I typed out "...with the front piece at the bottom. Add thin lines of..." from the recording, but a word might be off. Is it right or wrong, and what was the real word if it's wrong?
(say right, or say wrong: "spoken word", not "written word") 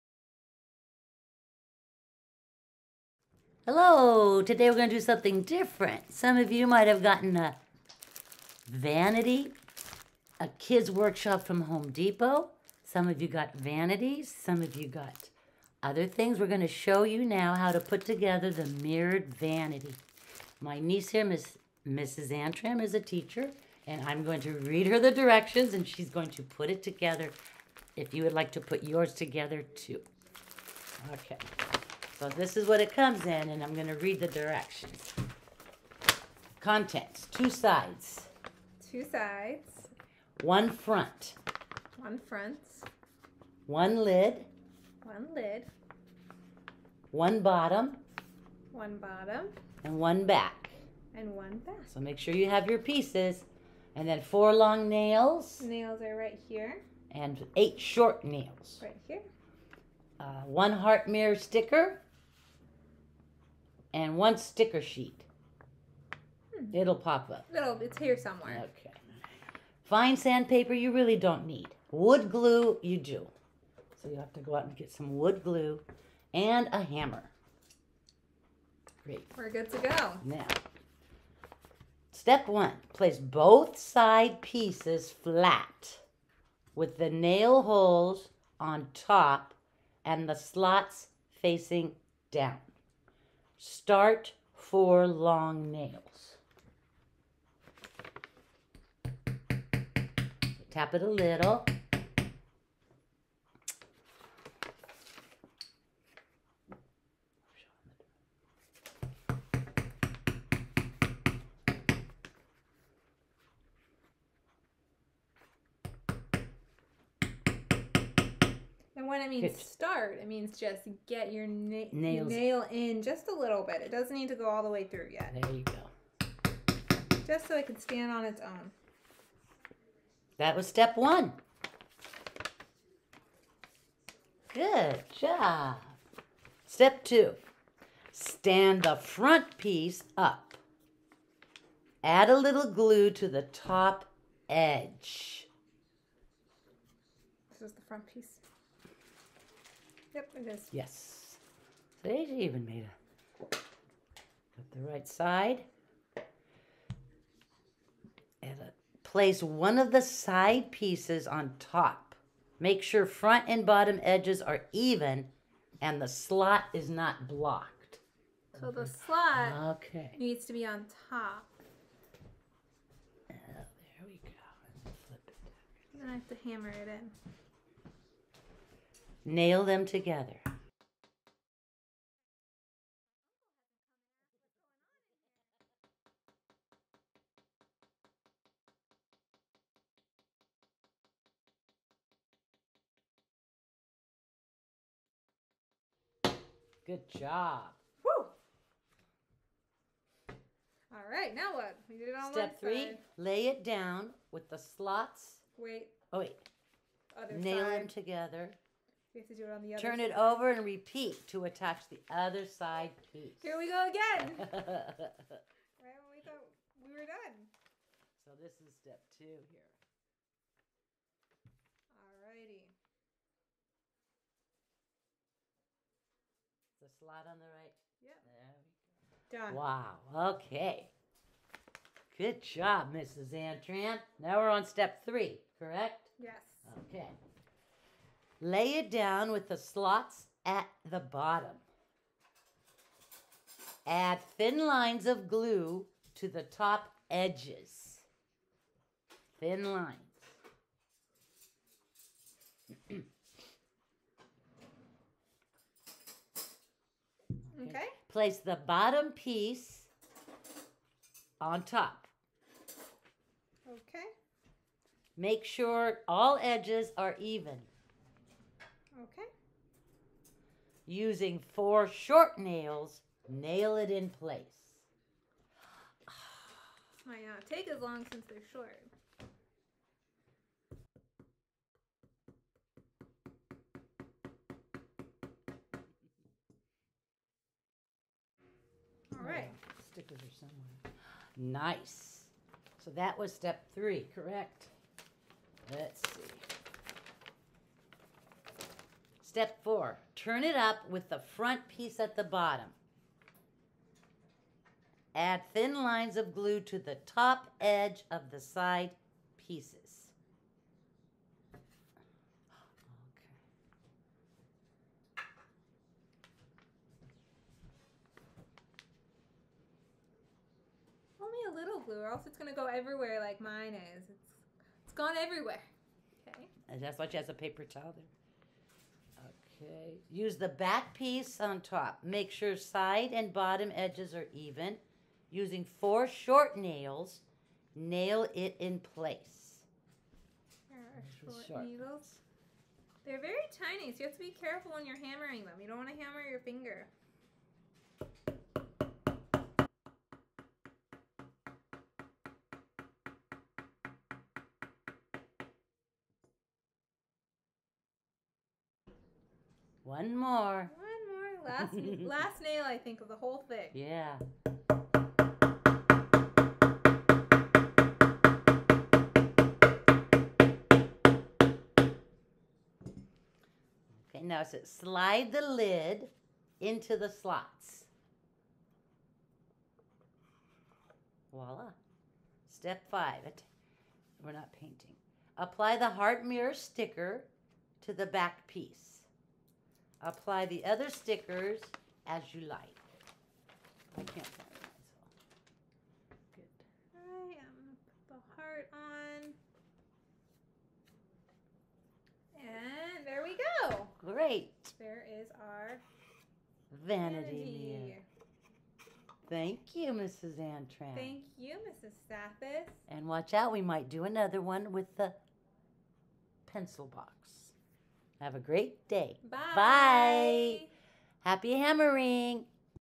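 right.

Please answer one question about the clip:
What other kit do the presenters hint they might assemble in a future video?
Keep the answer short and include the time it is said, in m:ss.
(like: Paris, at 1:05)
pencil box, at 6:54.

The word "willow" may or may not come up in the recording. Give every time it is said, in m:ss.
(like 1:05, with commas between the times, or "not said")
not said.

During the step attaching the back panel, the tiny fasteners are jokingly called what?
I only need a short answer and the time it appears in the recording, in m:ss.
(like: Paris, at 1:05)
needles, at 5:41.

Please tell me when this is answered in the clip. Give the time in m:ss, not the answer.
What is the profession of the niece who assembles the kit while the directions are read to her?
0:22.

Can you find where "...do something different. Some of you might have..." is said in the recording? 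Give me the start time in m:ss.
0:04.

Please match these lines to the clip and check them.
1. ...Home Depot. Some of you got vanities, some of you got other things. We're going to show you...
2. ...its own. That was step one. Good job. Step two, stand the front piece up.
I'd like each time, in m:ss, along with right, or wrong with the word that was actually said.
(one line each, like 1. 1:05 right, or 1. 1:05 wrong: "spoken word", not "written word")
1. 0:11 right
2. 2:08 right.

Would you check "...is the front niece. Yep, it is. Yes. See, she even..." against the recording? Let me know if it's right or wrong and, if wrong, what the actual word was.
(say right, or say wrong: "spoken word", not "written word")
wrong: "piece", not "niece".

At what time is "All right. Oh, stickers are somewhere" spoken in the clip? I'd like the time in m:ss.
4:49.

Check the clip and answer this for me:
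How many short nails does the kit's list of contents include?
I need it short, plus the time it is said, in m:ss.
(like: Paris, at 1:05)
8, at 0:57.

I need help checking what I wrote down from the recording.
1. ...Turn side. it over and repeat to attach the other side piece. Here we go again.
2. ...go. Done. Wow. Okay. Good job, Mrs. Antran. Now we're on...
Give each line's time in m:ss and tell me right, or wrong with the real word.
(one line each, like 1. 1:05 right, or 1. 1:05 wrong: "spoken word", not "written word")
1. 3:29 right
2. 3:49 right.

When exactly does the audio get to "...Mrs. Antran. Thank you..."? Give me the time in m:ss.
6:49.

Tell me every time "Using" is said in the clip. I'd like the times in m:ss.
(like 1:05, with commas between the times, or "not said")
4:30, 5:35.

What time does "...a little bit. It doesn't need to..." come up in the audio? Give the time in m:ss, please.
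2:03.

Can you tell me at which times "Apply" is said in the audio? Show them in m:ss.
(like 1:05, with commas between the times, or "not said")
6:25, 6:30.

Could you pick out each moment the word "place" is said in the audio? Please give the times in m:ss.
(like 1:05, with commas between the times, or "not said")
1:22, 2:39, 4:18, 4:34, 5:38.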